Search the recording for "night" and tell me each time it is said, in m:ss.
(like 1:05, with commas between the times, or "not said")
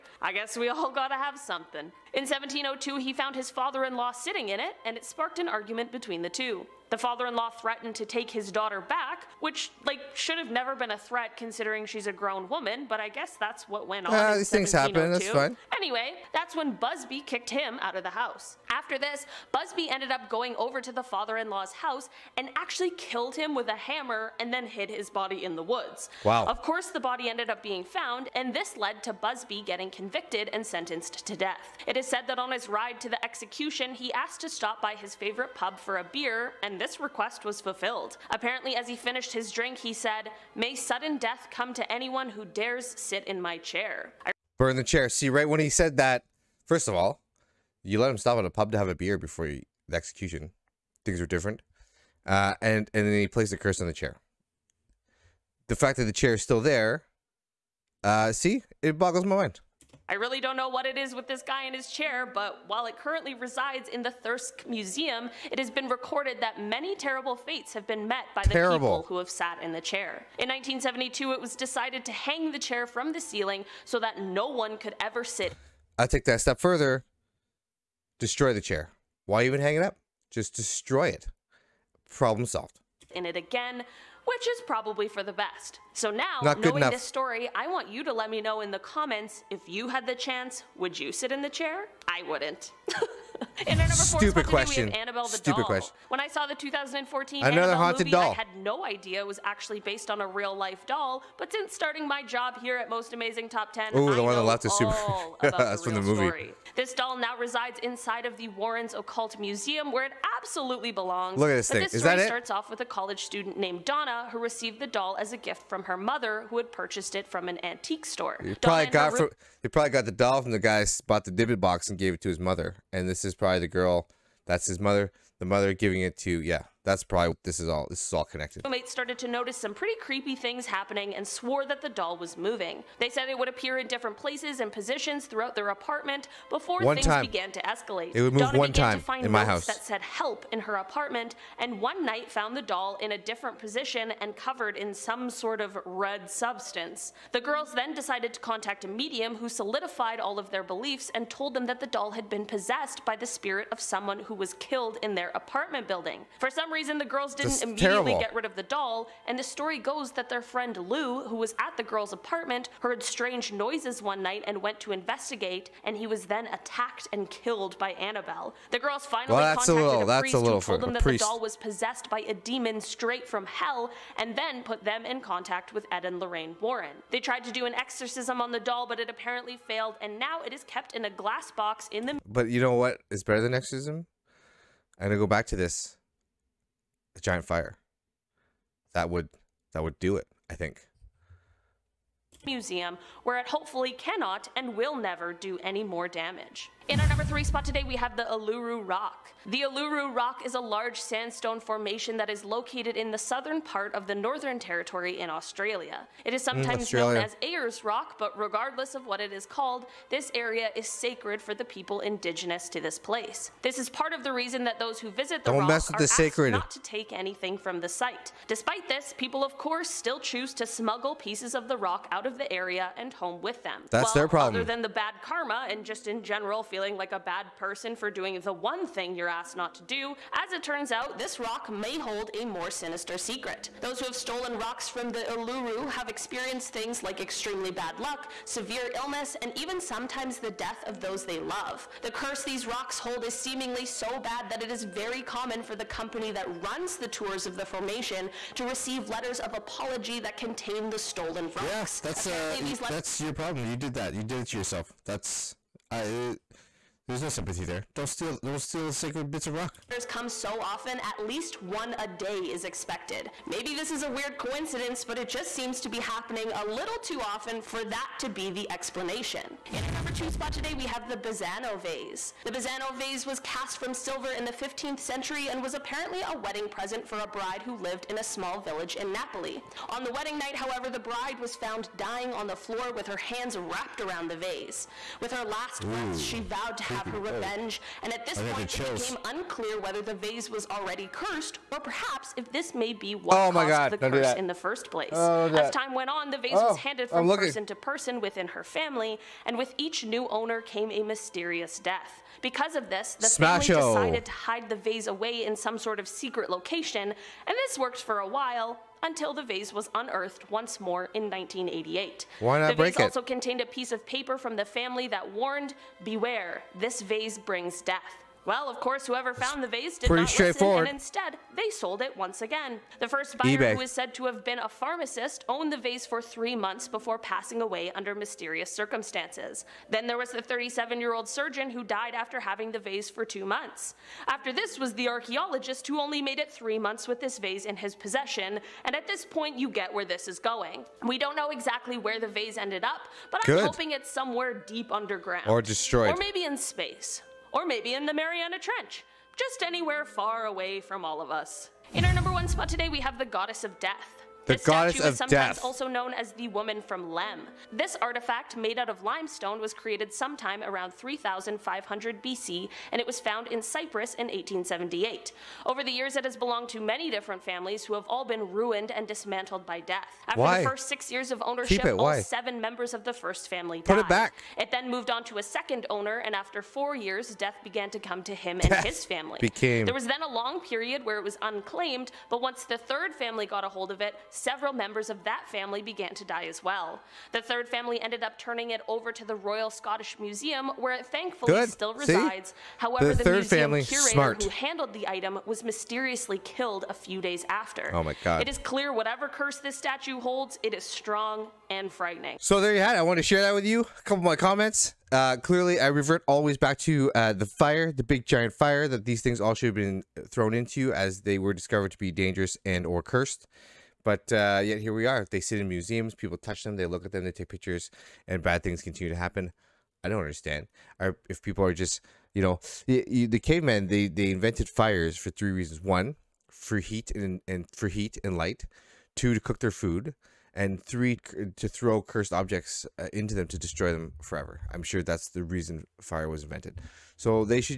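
2:22, 2:44, 4:40.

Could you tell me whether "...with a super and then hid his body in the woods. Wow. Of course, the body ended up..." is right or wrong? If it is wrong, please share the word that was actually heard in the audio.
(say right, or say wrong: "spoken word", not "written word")
wrong: "hammer", not "super".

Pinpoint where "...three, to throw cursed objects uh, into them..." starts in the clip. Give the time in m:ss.
7:10.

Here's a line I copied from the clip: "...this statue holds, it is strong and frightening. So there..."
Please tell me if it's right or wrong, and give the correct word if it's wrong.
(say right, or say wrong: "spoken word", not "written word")
right.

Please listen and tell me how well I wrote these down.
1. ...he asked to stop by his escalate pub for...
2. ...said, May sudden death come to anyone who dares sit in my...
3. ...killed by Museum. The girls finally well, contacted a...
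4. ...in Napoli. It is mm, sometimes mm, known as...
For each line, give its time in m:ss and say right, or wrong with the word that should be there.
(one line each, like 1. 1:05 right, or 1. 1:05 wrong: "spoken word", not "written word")
1. 0:33 wrong: "favorite", not "escalate"
2. 0:39 right
3. 2:47 wrong: "Annabelle", not "Museum"
4. 3:25 wrong: "Australia", not "Napoli".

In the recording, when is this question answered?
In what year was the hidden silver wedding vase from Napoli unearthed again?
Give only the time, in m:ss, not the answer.
5:11.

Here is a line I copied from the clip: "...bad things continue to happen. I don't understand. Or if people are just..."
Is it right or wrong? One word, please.
right.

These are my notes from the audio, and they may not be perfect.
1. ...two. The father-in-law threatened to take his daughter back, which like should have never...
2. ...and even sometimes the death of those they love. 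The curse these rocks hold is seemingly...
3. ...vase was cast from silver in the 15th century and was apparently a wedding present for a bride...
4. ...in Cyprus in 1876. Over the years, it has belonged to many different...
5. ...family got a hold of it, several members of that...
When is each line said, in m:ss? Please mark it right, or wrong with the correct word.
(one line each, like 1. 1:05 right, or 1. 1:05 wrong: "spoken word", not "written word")
1. 0:06 right
2. 3:59 right
3. 4:32 right
4. 6:03 wrong: "1878", not "1876"
5. 6:23 right.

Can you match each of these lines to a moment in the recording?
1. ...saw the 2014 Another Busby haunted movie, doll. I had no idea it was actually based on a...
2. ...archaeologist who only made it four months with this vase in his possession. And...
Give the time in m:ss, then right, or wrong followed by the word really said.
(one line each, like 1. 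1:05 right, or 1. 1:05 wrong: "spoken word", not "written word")
1. 1:36 wrong: "Annabelle", not "Busby"
2. 5:35 wrong: "three", not "four".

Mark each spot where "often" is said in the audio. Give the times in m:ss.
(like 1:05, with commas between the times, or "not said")
4:20, 4:27.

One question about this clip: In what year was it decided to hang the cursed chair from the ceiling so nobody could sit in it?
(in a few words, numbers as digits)
1972.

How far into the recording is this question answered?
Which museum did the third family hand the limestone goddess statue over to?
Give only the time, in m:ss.
6:29.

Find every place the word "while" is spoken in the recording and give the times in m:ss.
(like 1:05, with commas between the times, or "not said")
1:02, 5:08.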